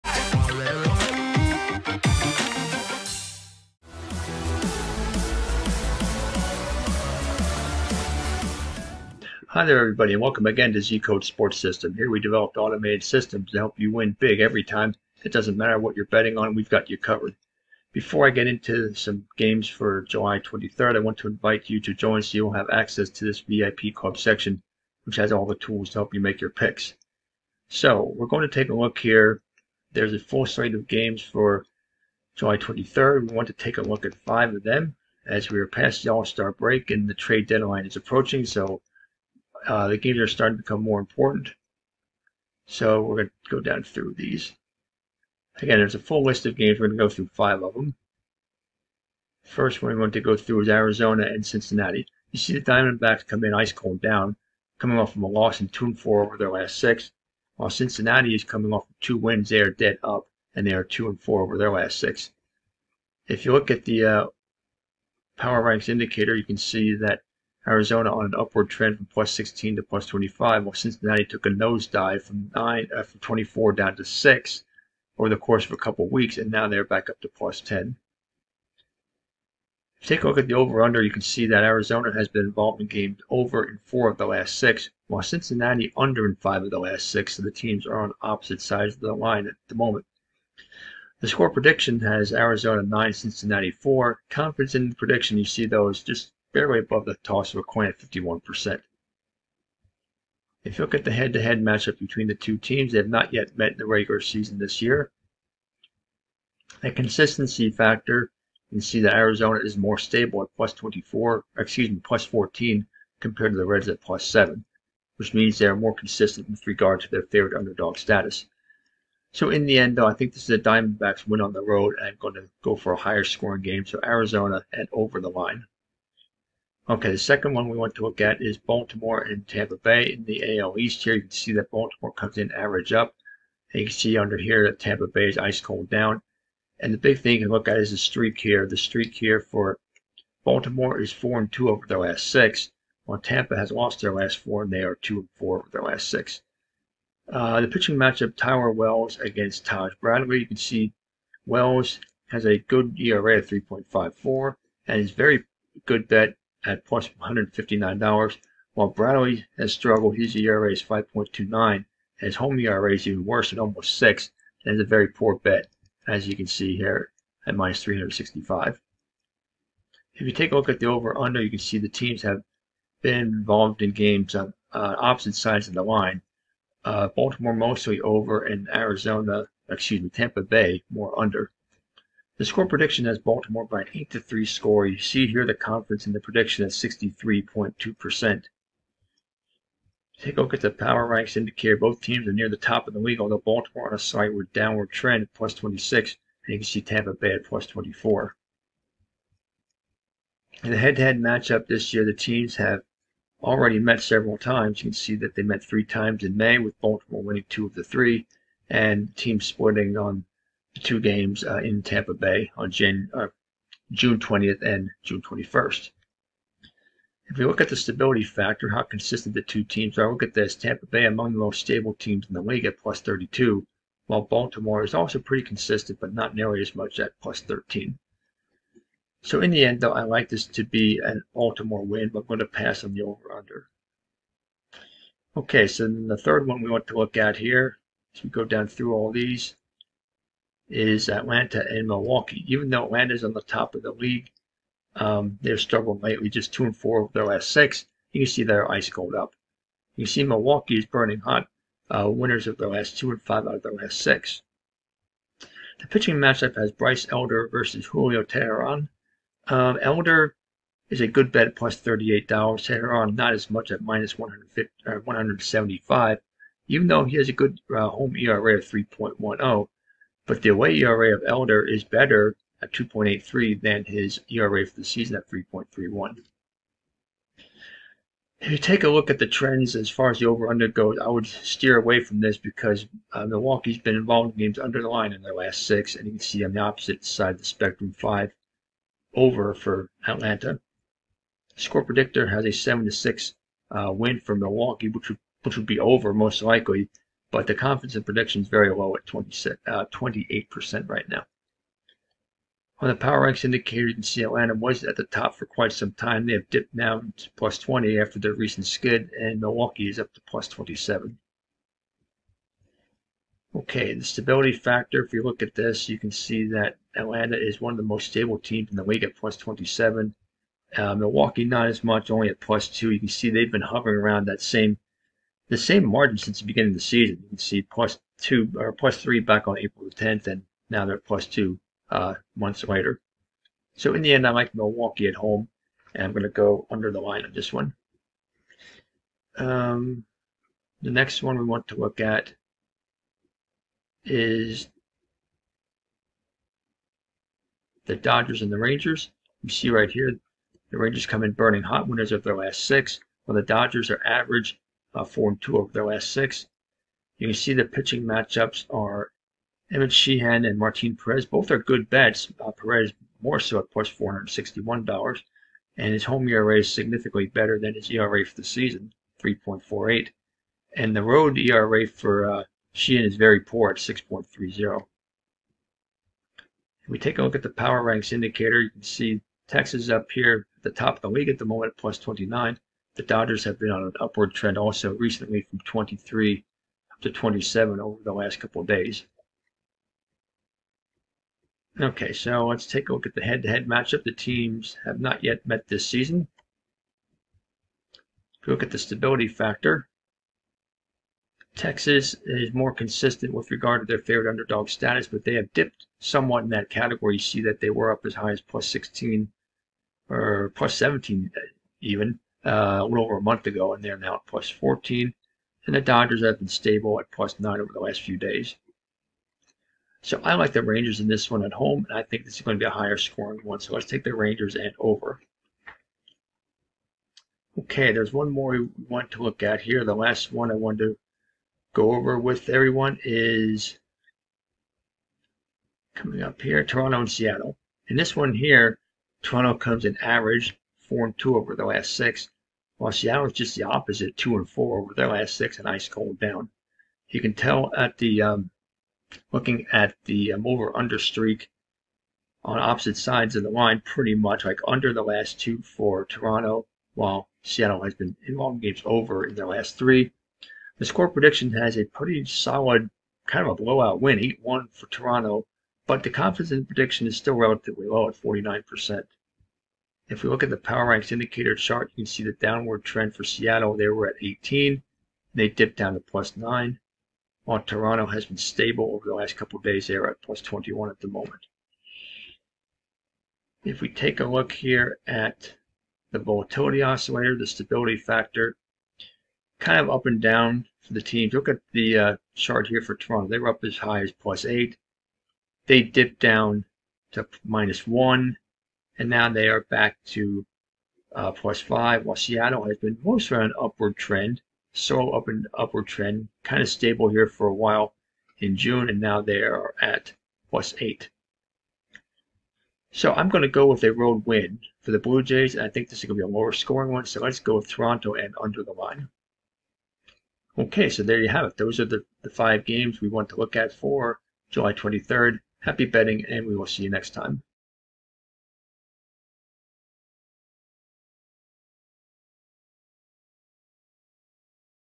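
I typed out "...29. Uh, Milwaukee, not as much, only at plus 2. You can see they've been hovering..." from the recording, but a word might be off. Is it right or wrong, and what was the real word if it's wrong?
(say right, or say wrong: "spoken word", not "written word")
wrong: "27", not "29".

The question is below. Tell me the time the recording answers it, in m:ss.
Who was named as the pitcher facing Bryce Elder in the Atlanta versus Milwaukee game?
4:17.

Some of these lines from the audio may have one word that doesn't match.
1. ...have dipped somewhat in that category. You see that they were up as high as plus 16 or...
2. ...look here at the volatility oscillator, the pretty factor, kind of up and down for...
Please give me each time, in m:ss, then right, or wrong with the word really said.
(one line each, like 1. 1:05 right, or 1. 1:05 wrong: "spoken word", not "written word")
1. 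6:45 right
2. 8:04 wrong: "stability", not "pretty".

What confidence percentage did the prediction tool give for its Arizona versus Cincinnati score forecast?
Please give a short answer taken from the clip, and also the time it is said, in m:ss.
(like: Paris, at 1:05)
51%, at 1:37.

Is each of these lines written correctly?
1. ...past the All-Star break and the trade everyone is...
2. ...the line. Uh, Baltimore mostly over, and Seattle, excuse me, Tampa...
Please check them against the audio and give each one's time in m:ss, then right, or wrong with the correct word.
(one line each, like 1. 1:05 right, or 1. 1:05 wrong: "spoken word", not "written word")
1. 0:35 wrong: "deadline", not "everyone"
2. 2:55 wrong: "Arizona", not "Seattle".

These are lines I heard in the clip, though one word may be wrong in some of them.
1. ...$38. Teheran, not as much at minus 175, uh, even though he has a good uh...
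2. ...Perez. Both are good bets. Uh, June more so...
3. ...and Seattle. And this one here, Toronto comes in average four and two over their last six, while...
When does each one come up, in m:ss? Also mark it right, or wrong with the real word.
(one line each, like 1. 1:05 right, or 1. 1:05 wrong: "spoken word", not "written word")
1. 4:21 right
2. 6:00 wrong: "Perez", not "June"
3. 7:17 right.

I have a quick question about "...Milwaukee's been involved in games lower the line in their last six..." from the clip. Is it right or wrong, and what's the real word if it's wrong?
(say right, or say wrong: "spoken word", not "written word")
wrong: "under", not "lower".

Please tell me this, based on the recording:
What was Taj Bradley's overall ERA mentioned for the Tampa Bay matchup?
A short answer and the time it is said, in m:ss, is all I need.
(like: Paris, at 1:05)
5.29, at 2:40.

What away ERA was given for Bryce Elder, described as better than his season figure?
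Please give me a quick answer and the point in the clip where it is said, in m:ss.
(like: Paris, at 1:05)
2.83, at 4:32.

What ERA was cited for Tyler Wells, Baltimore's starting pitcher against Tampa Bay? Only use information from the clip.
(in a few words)
3.54.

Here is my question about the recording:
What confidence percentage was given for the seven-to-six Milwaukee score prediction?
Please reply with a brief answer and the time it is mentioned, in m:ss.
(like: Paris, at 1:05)
28%, at 4:59.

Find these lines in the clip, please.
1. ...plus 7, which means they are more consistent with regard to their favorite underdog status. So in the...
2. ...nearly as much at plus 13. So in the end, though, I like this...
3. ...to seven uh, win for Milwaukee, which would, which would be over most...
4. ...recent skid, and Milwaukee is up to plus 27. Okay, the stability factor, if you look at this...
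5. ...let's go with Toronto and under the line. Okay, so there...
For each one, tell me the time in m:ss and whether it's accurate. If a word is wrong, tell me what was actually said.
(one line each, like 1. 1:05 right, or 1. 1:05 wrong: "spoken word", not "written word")
1. 1:54 right
2. 3:46 right
3. 4:52 wrong: "six", not "seven"
4. 5:08 right
5. 8:37 right.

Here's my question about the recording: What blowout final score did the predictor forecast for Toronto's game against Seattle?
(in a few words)
8-1.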